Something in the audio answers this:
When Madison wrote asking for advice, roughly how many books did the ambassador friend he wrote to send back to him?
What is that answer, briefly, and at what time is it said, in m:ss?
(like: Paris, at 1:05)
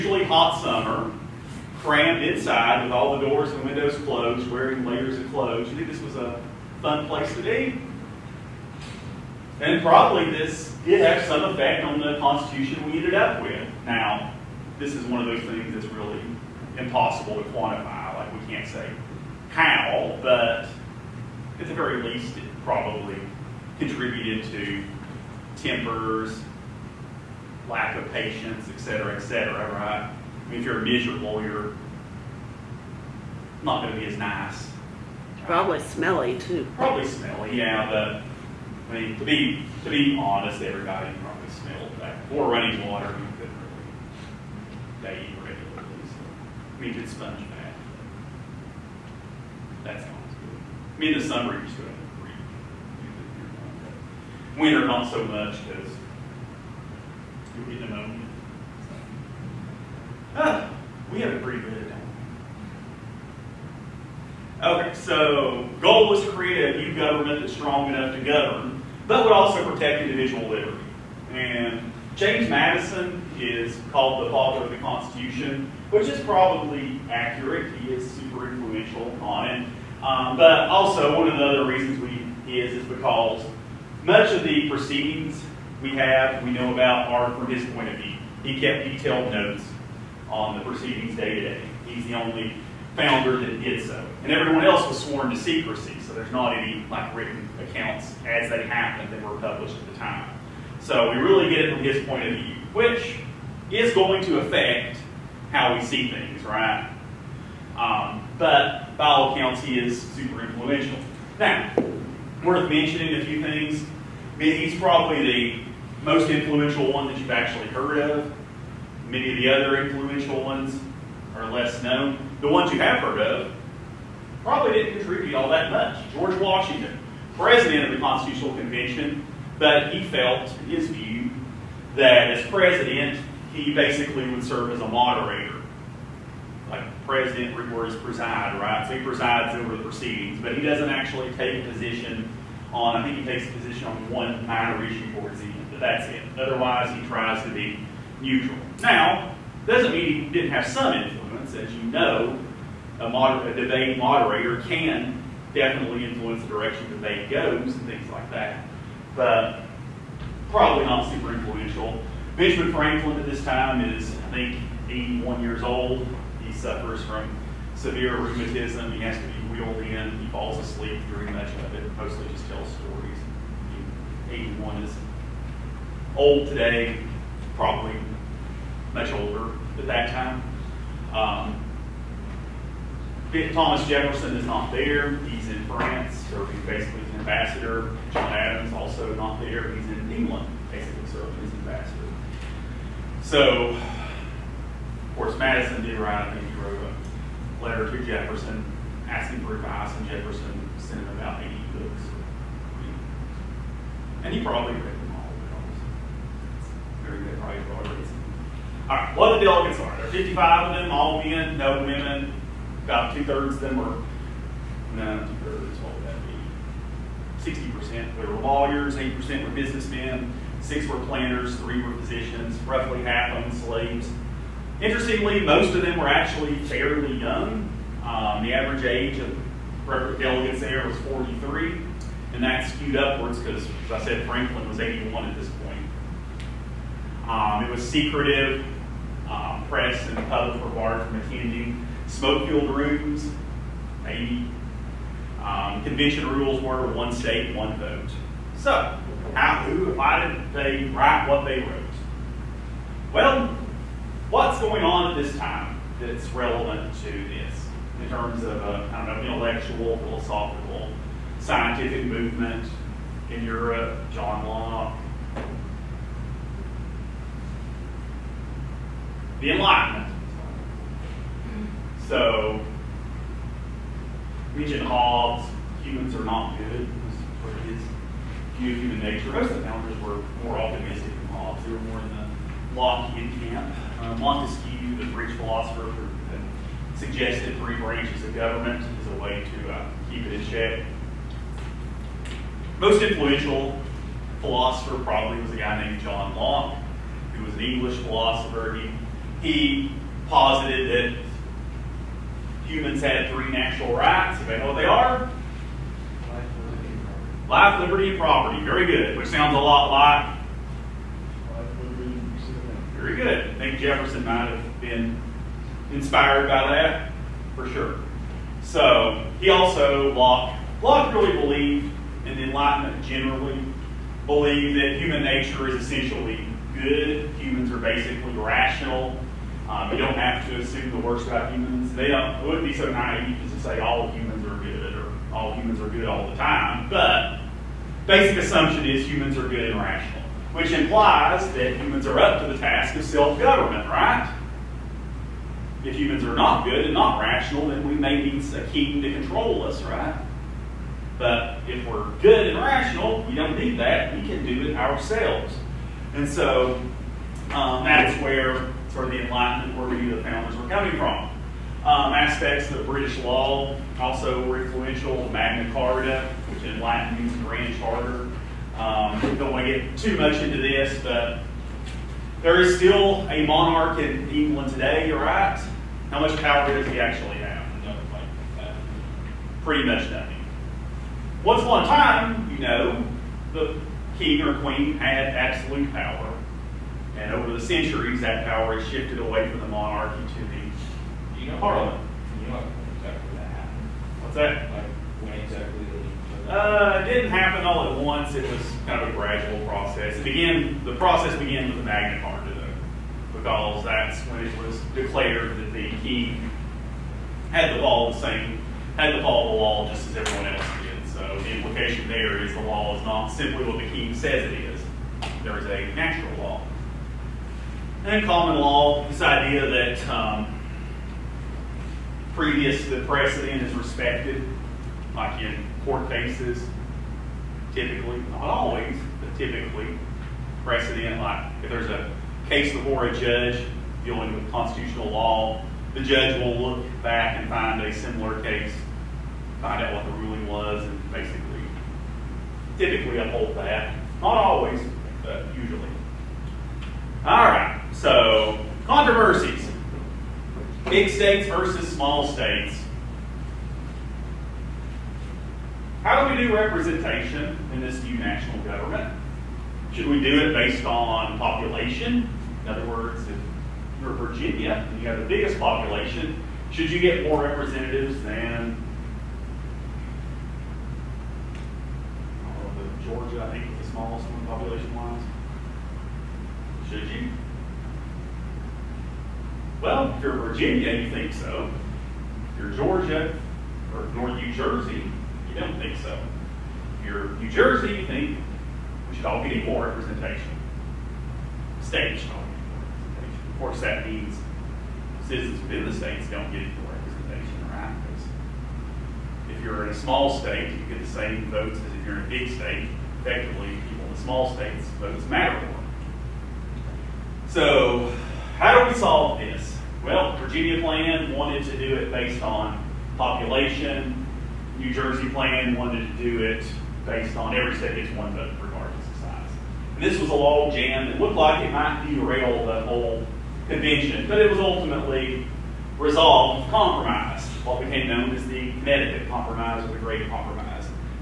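80, at 3:21.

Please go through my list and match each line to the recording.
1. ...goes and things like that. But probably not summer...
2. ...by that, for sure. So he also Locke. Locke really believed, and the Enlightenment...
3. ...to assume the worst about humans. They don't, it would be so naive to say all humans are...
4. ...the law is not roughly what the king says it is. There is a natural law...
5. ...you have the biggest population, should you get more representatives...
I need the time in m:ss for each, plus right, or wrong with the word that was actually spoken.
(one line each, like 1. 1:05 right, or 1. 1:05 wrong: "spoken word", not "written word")
1. 2:37 wrong: "super", not "summer"
2. 5:16 right
3. 5:30 right
4. 6:52 wrong: "simply", not "roughly"
5. 7:45 right.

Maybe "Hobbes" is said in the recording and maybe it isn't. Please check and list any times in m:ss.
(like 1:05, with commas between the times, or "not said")
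4:34, 4:41.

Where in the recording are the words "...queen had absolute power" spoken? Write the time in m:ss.
6:24.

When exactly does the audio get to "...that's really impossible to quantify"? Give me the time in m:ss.
0:15.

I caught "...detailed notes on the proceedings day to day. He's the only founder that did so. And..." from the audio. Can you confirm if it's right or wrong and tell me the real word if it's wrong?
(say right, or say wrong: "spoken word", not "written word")
right.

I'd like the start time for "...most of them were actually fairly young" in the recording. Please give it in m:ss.
3:45.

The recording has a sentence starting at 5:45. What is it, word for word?
If humans are not good and not rational, then we may need a king to control us, right?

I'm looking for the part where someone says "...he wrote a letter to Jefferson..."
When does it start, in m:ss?
3:16.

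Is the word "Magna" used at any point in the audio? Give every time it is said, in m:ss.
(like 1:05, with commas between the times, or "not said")
6:05, 6:41.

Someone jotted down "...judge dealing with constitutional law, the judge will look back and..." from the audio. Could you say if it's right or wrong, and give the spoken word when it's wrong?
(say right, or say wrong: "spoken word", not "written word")
right.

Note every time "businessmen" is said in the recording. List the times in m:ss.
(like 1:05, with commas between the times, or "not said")
3:39.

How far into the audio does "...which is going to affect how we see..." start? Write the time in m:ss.
1:42.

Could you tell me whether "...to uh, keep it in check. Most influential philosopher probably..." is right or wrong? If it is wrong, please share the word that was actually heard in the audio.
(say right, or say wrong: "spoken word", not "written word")
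right.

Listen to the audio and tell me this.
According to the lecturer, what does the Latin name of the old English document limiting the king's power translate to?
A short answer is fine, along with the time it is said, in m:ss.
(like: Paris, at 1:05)
Grand Charter, at 6:07.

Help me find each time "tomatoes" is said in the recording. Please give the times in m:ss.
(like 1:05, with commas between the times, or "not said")
not said.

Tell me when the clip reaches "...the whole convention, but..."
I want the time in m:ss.
8:42.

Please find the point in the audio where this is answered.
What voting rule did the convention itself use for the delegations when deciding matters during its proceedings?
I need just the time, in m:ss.
4:06.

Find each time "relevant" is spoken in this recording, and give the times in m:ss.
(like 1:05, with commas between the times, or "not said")
4:16.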